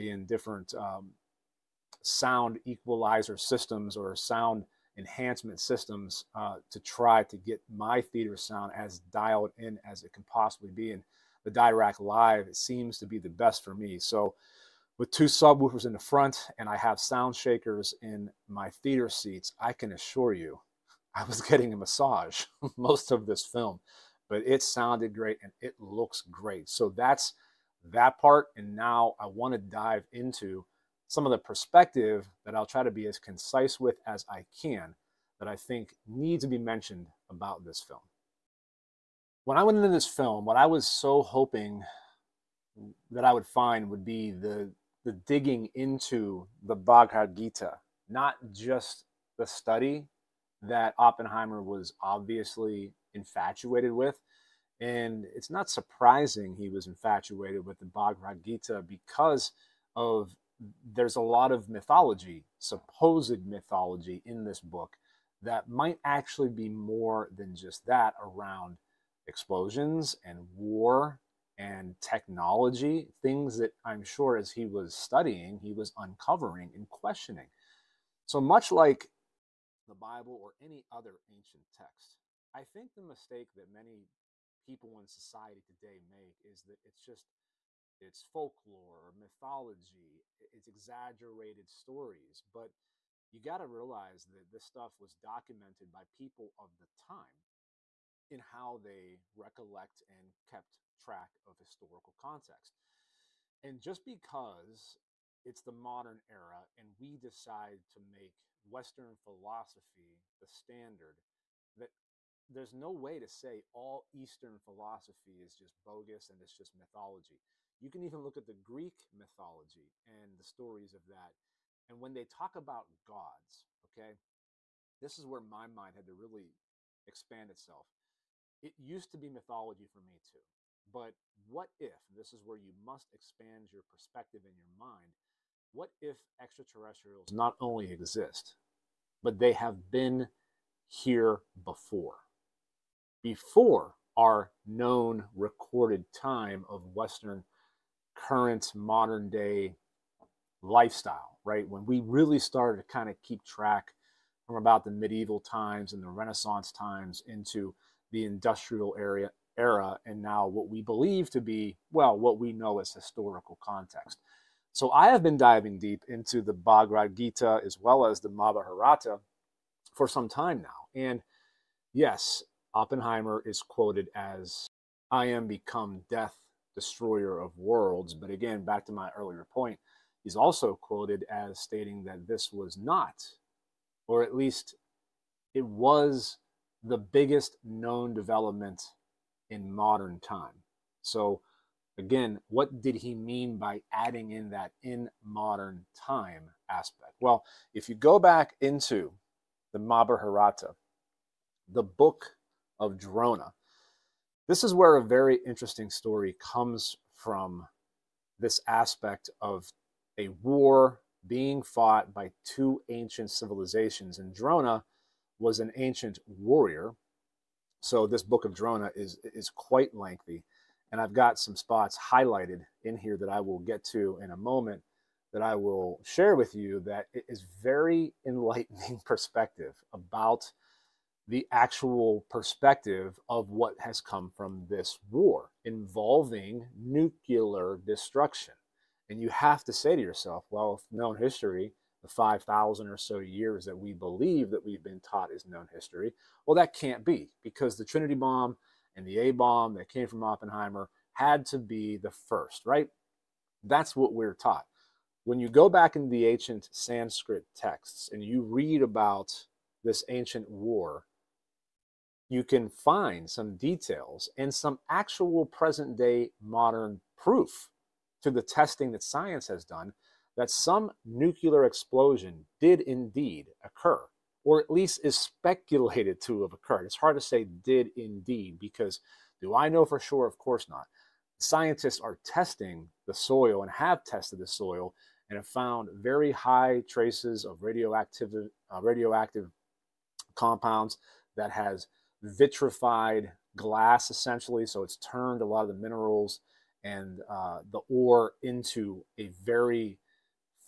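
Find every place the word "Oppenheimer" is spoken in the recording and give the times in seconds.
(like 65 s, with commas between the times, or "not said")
50 s, 172 s, 250 s.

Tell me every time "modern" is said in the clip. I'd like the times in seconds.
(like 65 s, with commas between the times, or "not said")
105 s, 148 s, 189 s, 195 s, 266 s.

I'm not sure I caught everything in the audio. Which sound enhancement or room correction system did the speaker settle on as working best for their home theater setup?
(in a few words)
Dirac Live.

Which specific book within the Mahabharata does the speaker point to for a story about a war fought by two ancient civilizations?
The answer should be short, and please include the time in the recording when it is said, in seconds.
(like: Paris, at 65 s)
The book of Drona, at 201 s.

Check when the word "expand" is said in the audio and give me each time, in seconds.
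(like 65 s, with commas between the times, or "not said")
127 s, 133 s.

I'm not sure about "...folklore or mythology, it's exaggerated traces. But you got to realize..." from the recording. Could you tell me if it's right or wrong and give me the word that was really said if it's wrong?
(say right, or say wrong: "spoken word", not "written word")
wrong: "stories", not "traces".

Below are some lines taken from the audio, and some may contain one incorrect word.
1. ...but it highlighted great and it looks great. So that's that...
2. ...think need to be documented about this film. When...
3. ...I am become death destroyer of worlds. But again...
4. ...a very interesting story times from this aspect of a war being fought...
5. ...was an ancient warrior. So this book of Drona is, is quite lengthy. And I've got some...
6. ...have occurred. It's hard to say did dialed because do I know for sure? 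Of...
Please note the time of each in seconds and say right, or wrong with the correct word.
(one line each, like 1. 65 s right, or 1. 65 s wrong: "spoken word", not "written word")
1. 24 s wrong: "sounded", not "highlighted"
2. 35 s wrong: "mentioned", not "documented"
3. 175 s right
4. 204 s wrong: "comes", not "times"
5. 215 s right
6. 276 s wrong: "indeed", not "dialed".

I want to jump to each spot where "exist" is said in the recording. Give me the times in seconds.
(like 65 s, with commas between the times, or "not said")
137 s.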